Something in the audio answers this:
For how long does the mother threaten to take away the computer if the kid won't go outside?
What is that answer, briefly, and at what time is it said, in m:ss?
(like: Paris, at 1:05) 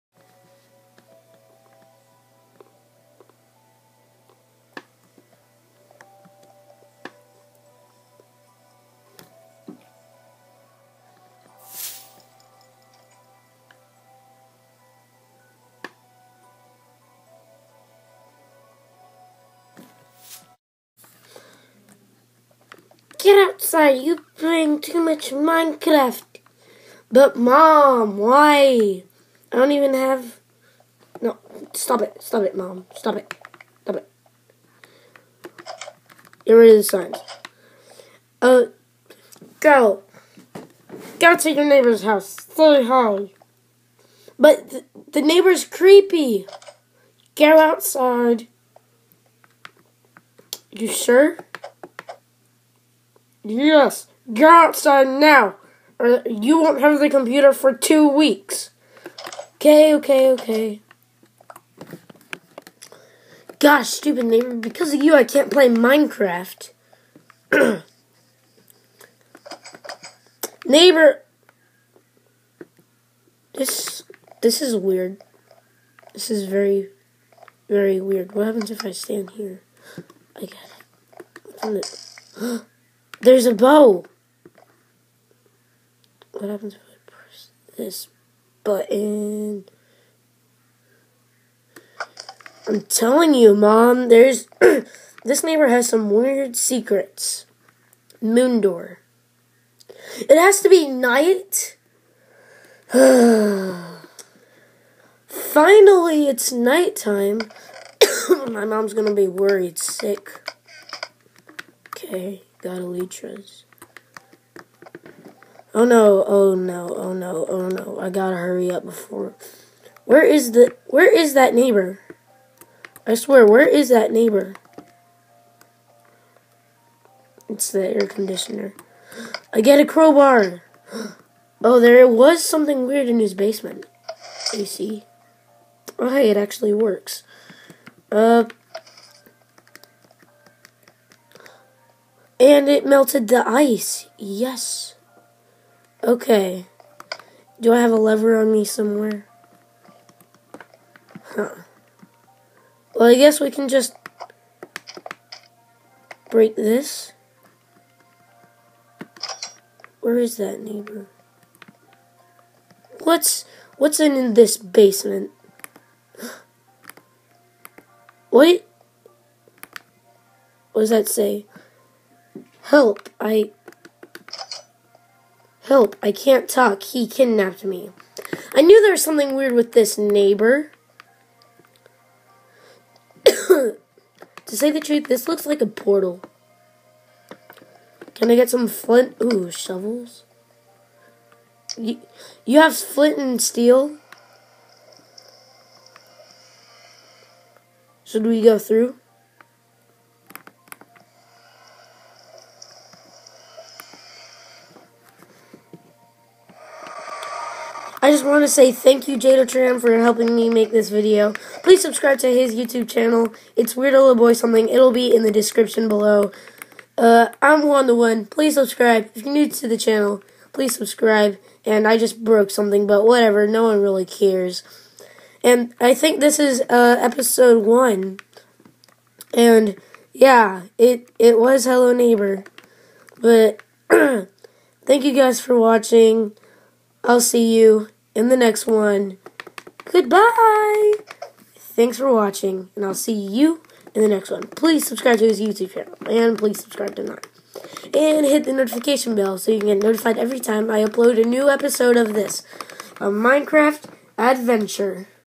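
2 weeks, at 0:57.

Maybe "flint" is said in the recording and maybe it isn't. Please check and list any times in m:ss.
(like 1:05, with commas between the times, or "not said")
3:08, 3:12.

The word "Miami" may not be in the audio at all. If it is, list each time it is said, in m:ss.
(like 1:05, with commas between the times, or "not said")
not said.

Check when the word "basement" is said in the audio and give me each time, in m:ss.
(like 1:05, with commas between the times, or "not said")
2:13, 2:44.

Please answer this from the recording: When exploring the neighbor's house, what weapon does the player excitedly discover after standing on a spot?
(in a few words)
A bow.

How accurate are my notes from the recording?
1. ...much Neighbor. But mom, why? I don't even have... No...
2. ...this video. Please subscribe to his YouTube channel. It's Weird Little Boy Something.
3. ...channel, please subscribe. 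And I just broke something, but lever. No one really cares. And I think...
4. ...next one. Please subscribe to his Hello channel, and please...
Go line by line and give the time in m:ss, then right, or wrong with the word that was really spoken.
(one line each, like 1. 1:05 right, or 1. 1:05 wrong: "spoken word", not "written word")
1. 0:24 wrong: "Minecraft", not "Neighbor"
2. 3:30 right
3. 3:39 wrong: "whatever", not "lever"
4. 4:04 wrong: "YouTube", not "Hello".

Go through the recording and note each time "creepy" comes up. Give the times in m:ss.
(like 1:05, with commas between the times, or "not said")
0:45.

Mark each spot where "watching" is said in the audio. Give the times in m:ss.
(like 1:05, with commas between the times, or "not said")
3:55, 4:02.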